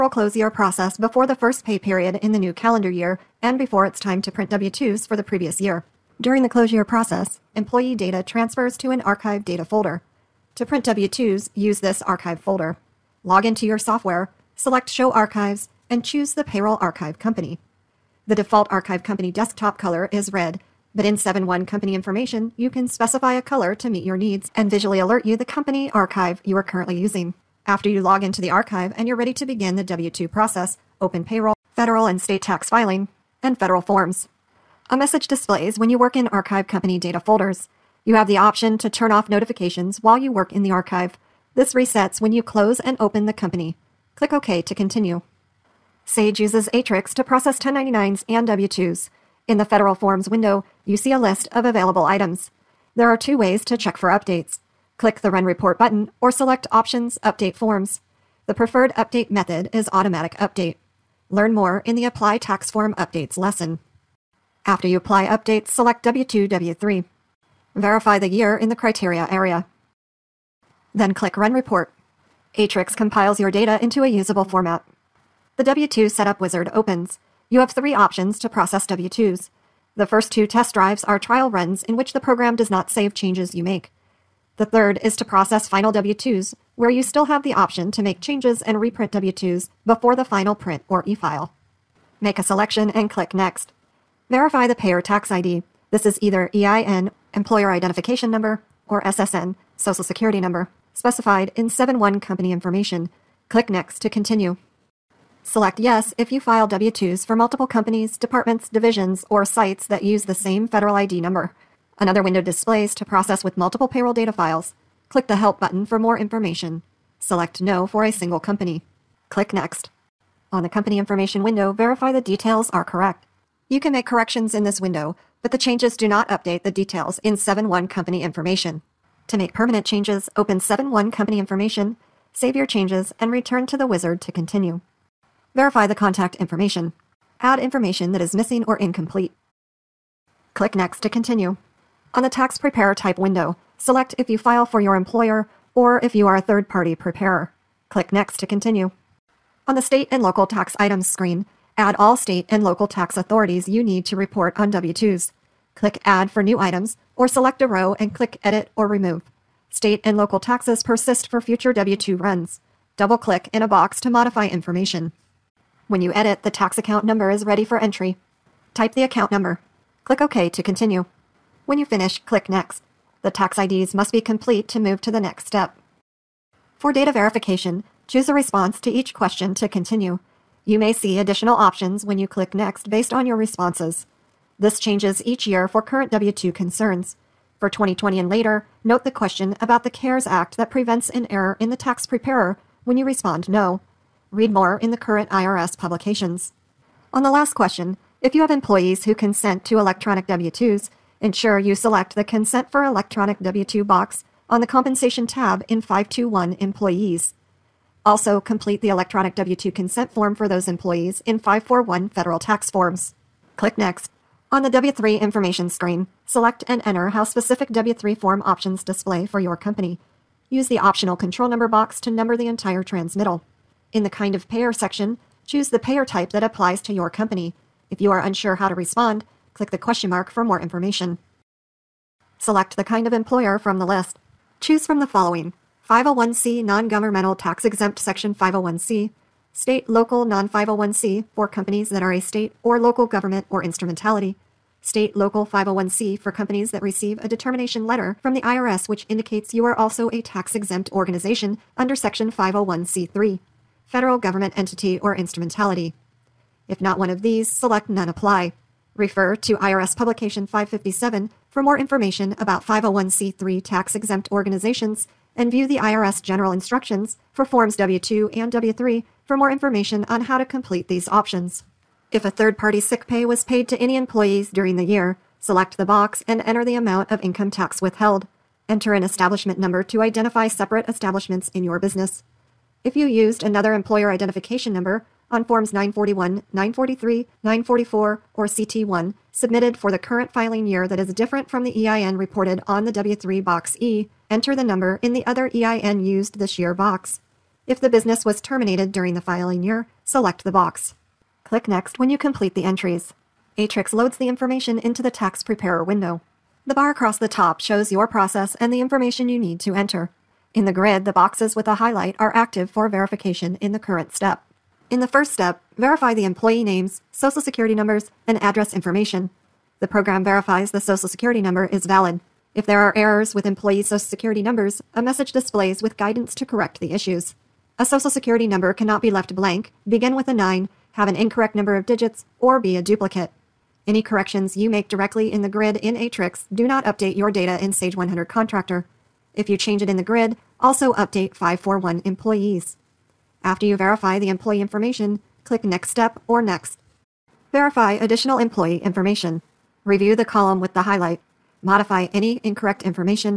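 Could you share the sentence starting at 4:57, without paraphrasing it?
If the business was terminated during the filing year, select the box.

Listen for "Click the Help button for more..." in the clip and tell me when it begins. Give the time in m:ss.
1:55.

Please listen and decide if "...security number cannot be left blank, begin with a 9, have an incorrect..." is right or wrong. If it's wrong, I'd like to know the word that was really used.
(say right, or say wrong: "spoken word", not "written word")
right.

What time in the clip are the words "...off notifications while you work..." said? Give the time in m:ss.
0:39.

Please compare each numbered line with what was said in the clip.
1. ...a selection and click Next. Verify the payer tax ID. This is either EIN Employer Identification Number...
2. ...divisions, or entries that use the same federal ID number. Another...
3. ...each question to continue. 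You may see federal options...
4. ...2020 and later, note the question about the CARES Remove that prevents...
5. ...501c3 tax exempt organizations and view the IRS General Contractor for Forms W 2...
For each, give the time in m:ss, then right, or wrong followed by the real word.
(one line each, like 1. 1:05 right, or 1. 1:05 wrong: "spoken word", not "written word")
1. 1:32 right
2. 1:48 wrong: "sites", not "entries"
3. 2:58 wrong: "additional", not "federal"
4. 3:07 wrong: "Act", not "Remove"
5. 4:22 wrong: "Instructions", not "Contractor".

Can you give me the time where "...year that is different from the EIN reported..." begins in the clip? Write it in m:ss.
4:50.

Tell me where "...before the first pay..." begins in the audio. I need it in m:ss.
0:00.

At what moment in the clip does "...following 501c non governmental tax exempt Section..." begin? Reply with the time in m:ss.
3:55.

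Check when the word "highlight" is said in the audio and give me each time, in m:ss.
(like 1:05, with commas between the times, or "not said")
5:11, 5:50.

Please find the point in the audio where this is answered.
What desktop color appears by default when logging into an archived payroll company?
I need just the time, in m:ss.
0:20.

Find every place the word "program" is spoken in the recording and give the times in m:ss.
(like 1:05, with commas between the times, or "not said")
1:22, 5:19.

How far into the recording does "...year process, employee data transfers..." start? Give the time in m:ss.
0:06.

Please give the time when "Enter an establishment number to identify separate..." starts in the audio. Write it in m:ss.
4:38.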